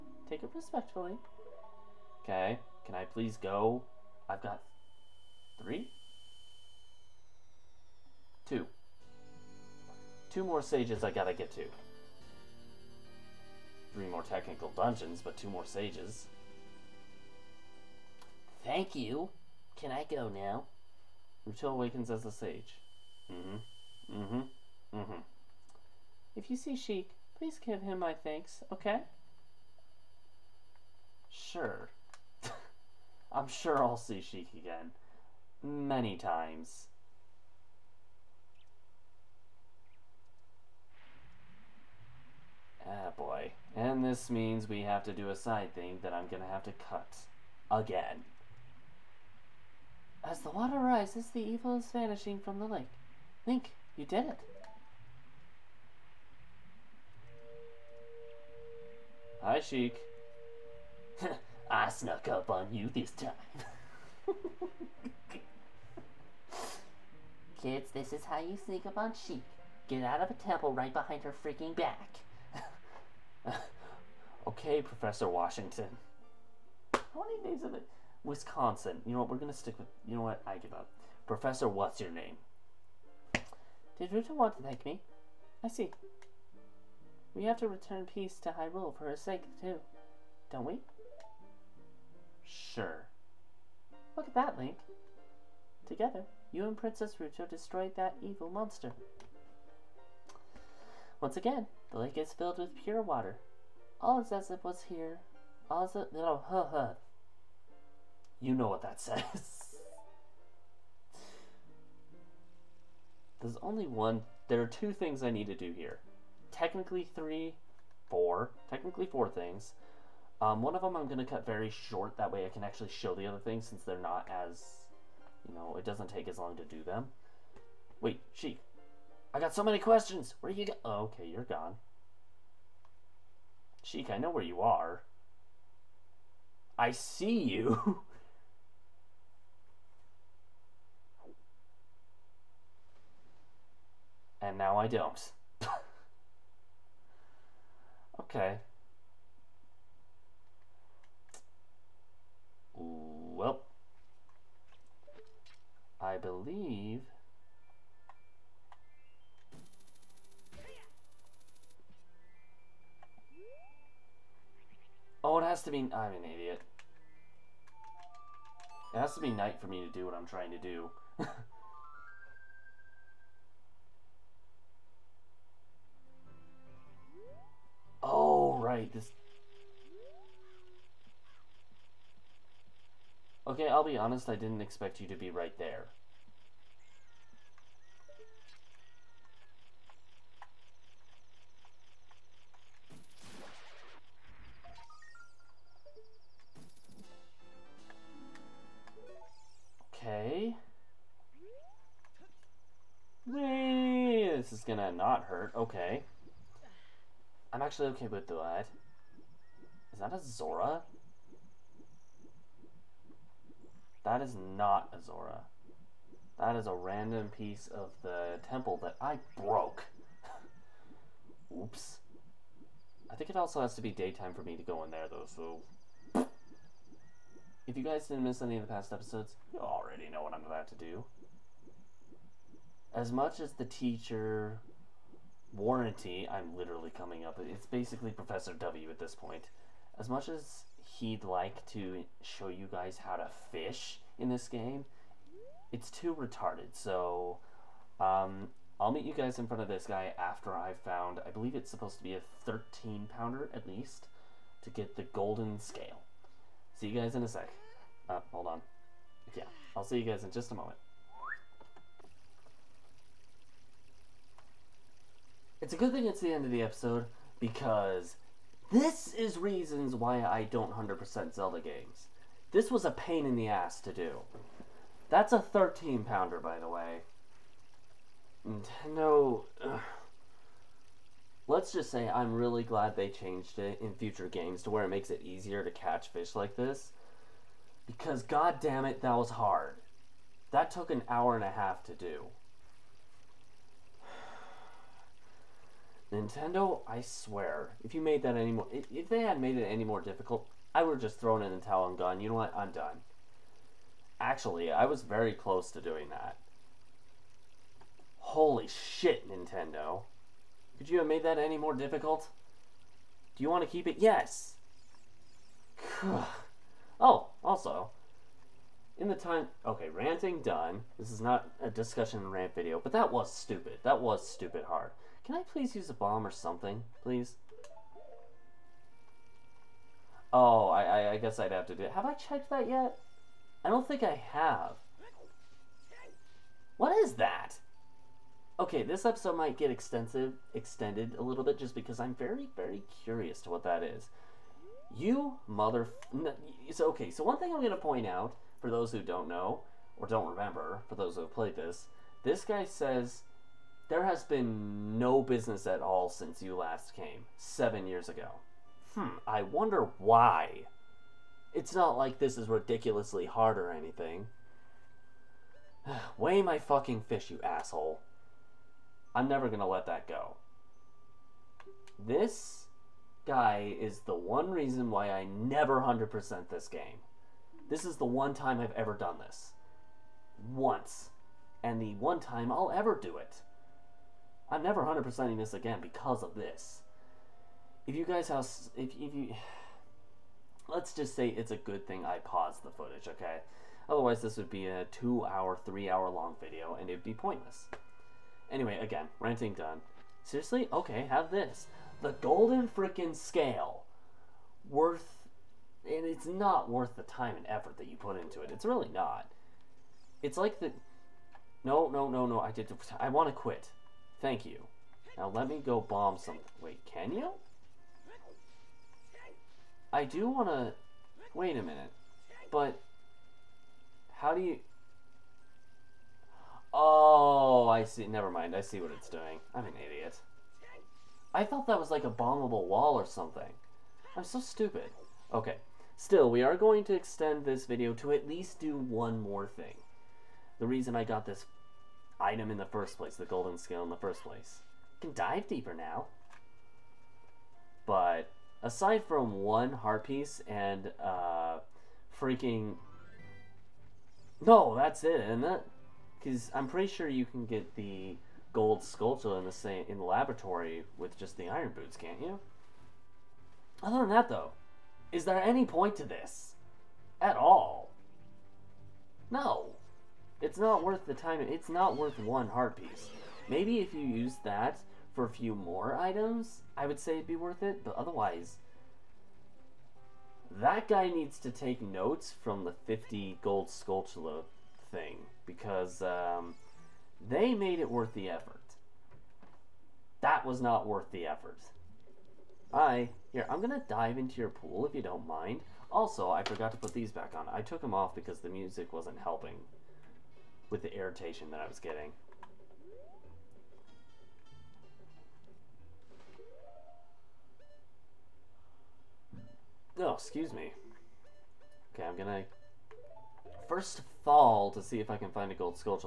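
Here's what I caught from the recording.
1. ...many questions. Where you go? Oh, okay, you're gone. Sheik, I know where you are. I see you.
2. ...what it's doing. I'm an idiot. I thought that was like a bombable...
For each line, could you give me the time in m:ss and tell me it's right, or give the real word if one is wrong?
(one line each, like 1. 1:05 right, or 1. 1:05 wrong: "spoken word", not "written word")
1. 2:09 right
2. 7:08 right.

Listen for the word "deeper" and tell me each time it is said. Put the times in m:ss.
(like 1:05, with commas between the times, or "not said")
7:25.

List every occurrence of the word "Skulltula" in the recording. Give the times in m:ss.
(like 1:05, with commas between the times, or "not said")
7:38, 8:03.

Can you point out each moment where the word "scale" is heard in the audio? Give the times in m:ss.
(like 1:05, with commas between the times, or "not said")
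4:15, 6:43, 7:23.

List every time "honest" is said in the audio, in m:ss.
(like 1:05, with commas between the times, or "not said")
3:03.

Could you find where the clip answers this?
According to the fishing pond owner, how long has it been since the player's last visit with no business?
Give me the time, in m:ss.
5:57.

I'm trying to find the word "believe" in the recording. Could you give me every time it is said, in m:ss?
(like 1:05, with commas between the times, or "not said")
2:36, 4:11.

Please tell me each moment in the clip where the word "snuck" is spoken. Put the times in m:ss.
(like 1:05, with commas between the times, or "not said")
1:01.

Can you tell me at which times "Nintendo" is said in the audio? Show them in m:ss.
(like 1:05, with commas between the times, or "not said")
4:38, 4:56, 5:09.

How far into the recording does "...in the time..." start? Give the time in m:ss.
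5:18.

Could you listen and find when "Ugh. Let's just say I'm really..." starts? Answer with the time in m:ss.
4:39.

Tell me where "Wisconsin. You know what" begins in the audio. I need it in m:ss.
1:18.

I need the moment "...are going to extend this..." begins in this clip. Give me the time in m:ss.
7:16.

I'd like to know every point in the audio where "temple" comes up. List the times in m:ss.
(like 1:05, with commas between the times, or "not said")
1:10, 3:38.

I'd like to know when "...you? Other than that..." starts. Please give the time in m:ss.
7:42.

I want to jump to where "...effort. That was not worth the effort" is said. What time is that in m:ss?
8:08.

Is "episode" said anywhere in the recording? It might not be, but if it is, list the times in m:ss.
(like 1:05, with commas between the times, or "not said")
3:48, 4:26, 5:39.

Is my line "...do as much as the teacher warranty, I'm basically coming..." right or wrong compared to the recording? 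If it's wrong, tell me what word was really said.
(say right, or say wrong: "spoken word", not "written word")
wrong: "literally", not "basically".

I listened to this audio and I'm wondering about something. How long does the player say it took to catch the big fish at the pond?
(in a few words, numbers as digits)
An hour and a half.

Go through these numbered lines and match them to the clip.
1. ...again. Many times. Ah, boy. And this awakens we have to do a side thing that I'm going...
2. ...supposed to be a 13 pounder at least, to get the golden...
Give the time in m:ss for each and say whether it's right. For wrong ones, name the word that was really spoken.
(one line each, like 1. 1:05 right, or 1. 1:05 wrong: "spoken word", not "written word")
1. 0:34 wrong: "means", not "awakens"
2. 4:11 right.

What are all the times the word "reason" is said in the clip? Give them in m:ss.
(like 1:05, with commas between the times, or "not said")
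4:29, 6:14, 7:20.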